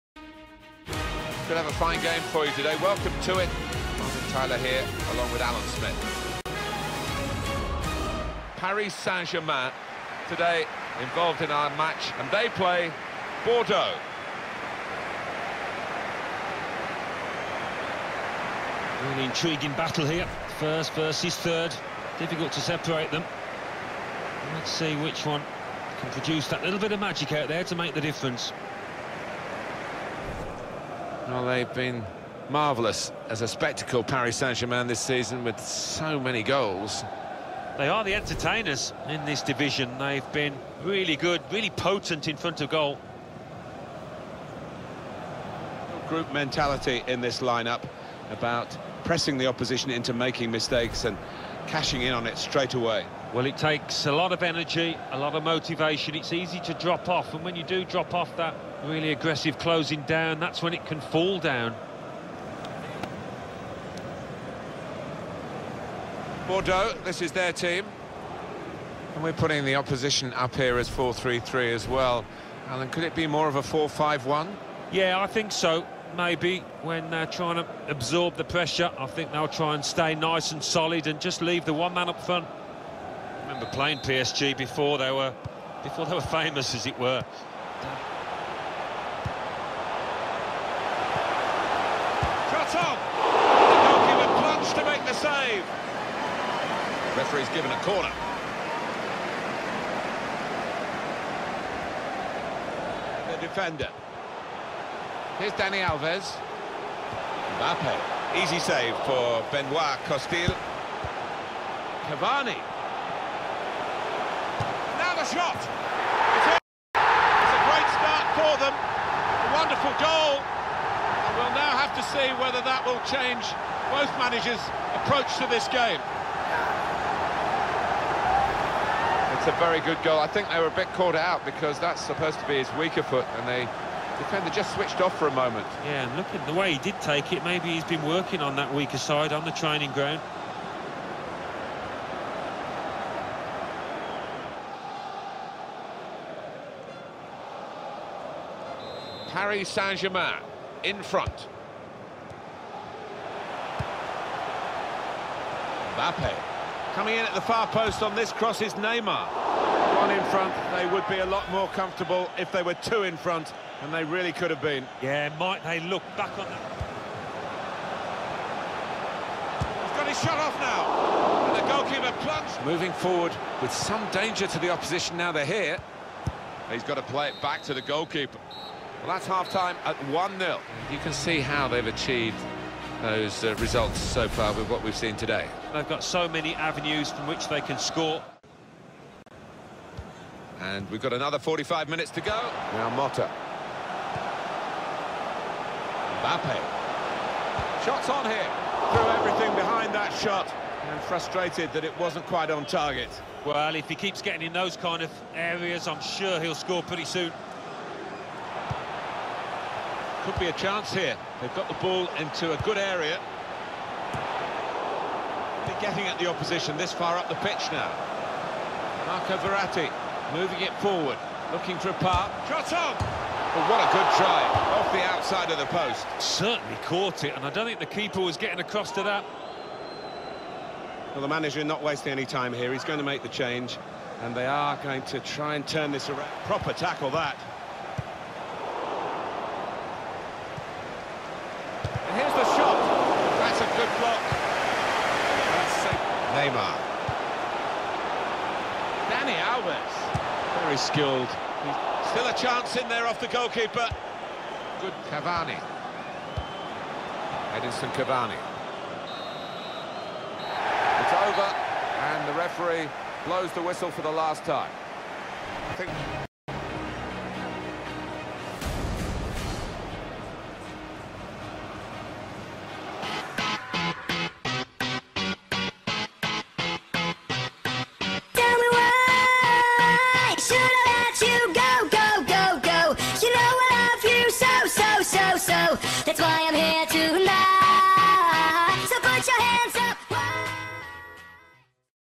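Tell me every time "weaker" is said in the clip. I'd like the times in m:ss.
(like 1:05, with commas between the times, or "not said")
2:12, 2:18.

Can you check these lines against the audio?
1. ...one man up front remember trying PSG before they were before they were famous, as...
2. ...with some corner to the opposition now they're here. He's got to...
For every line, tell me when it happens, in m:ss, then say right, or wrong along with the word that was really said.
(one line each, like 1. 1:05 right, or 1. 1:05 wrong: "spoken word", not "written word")
1. 1:21 wrong: "playing", not "trying"
2. 2:53 wrong: "danger", not "corner".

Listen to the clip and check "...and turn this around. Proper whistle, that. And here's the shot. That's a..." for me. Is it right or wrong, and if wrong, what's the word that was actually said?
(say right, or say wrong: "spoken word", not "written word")
wrong: "tackle", not "whistle".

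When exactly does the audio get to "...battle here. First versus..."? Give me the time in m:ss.
0:19.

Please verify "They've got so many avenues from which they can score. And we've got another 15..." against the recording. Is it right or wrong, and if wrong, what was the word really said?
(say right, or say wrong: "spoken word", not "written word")
wrong: "45", not "15".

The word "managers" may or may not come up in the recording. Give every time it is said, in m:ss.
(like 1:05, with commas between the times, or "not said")
2:04, 3:51.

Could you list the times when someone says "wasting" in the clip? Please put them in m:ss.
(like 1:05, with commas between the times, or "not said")
3:51.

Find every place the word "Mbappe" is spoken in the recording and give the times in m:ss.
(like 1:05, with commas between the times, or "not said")
1:47, 2:35, 3:16.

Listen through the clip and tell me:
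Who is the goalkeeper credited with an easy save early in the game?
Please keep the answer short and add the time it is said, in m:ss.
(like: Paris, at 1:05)
Benoit Costil, at 1:49.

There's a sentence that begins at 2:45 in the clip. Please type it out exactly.
Yeah, might they look back on that.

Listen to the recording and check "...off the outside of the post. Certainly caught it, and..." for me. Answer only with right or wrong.
right.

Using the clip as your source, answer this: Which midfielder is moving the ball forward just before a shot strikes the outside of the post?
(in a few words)
Marco Verratti.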